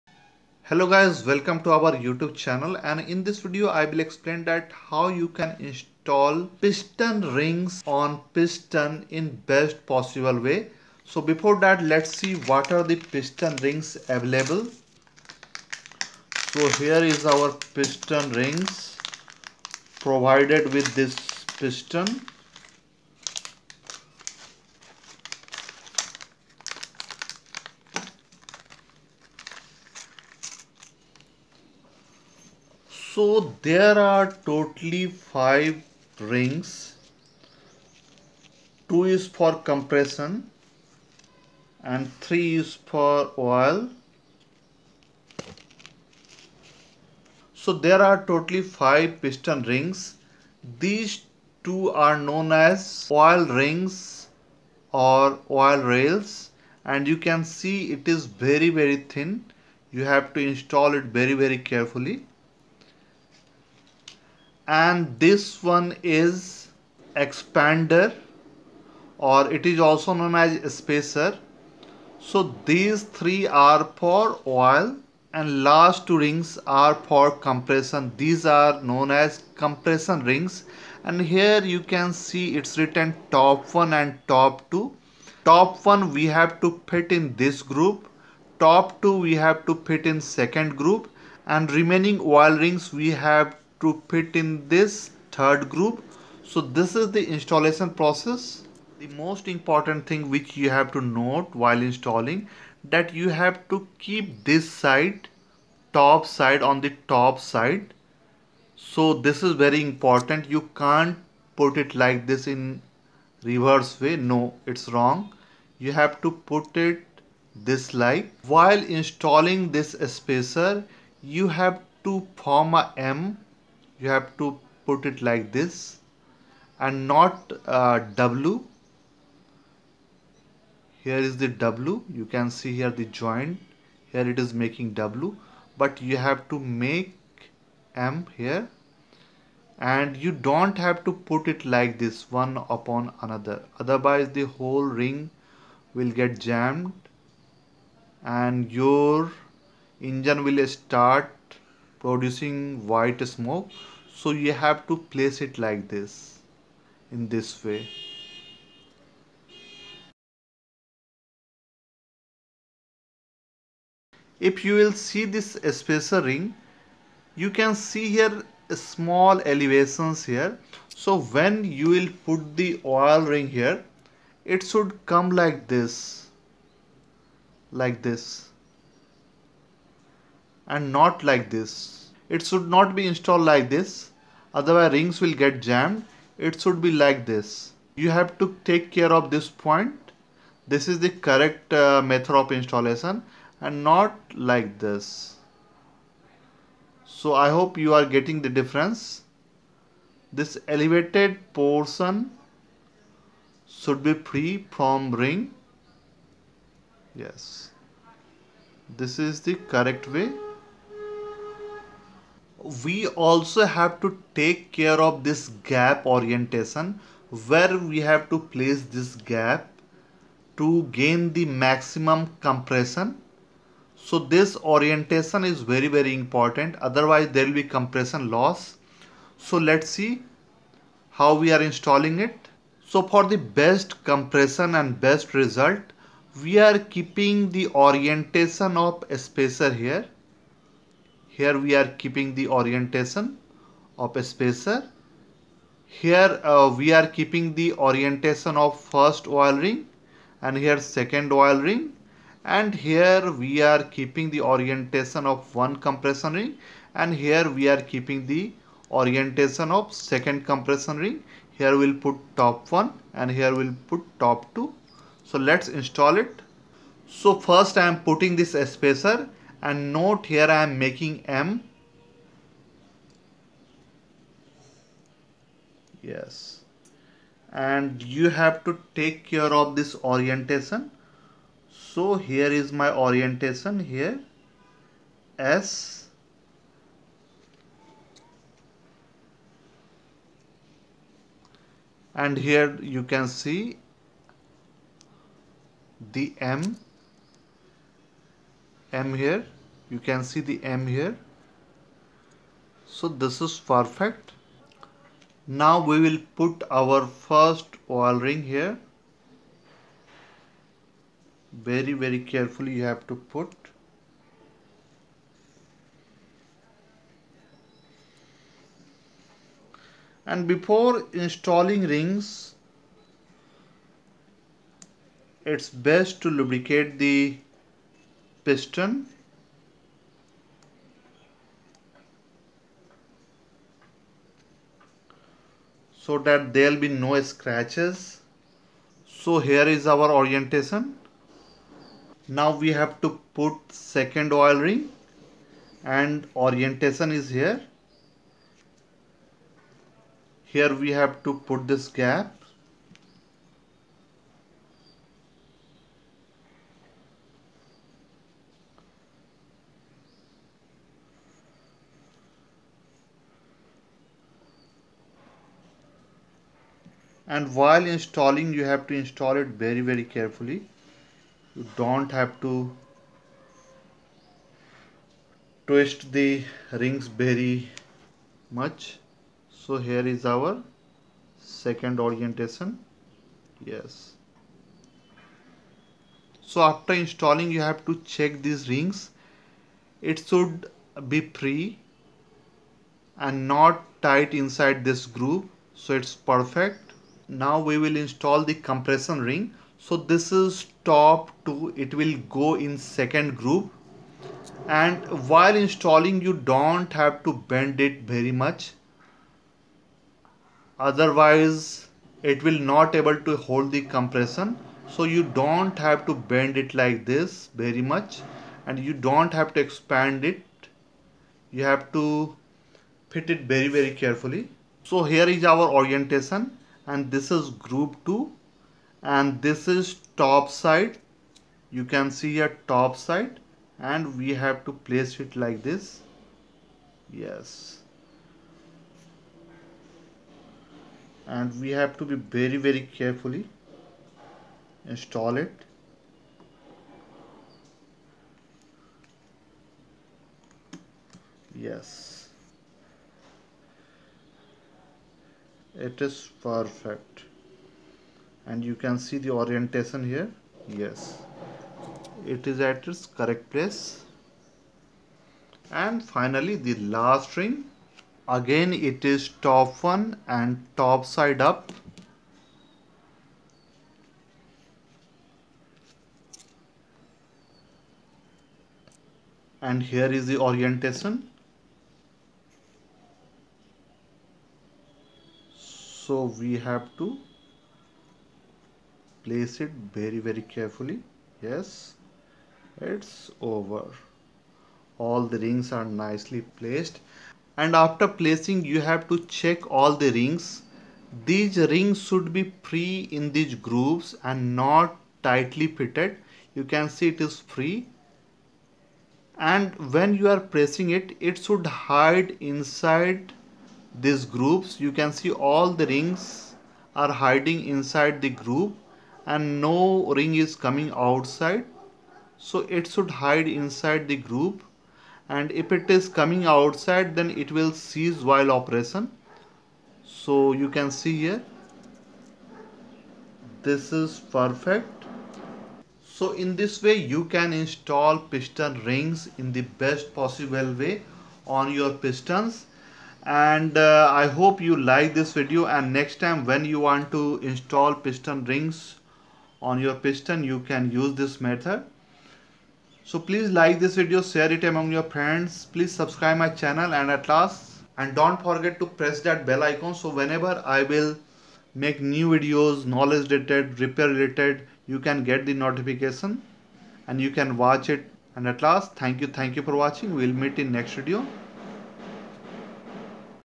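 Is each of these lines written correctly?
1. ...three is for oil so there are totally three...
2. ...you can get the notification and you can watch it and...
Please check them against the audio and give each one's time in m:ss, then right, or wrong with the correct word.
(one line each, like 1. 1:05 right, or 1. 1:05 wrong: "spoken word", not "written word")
1. 0:42 wrong: "five", not "three"
2. 9:24 right.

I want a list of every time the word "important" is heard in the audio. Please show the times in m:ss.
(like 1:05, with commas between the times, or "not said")
1:39, 1:49, 3:46.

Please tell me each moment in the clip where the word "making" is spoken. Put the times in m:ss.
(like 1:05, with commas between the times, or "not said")
2:14, 4:30.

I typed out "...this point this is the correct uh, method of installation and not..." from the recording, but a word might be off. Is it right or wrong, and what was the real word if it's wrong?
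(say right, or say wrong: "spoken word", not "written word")
right.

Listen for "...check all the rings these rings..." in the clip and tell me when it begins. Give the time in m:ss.
8:19.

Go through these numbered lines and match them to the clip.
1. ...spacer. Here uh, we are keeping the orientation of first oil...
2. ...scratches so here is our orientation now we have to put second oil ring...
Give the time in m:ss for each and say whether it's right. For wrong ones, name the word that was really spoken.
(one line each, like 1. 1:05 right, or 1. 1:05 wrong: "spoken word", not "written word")
1. 4:04 right
2. 5:37 right.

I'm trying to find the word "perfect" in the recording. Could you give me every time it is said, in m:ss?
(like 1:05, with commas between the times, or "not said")
5:03, 6:36, 7:36, 8:54.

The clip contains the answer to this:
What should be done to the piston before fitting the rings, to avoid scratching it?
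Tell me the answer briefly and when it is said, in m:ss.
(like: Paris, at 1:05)
Lubricate, at 5:26.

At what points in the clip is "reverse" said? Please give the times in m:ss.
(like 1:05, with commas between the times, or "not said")
1:53.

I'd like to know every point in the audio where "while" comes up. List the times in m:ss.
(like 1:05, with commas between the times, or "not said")
1:41, 1:58, 6:07, 6:45, 8:48.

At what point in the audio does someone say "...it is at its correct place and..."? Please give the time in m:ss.
7:42.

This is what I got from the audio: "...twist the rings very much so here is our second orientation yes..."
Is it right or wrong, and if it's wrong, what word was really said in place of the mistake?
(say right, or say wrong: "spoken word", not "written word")
right.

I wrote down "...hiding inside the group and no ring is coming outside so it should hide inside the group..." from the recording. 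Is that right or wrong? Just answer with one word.
right.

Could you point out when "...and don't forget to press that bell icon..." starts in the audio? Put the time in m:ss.
9:17.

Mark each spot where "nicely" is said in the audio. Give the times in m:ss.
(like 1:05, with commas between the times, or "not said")
8:15.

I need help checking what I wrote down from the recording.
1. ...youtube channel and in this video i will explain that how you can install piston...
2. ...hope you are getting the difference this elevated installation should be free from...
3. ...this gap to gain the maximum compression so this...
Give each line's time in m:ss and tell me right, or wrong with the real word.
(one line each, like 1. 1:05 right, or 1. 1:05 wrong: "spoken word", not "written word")
1. 0:02 right
2. 3:17 wrong: "portion", not "installation"
3. 3:38 right.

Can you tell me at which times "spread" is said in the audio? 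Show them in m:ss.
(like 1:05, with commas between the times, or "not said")
not said.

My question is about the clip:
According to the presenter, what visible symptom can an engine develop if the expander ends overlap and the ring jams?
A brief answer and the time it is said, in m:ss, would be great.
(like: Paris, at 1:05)
White smoke, at 2:32.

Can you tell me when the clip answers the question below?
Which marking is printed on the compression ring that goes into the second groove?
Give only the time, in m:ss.
6:40.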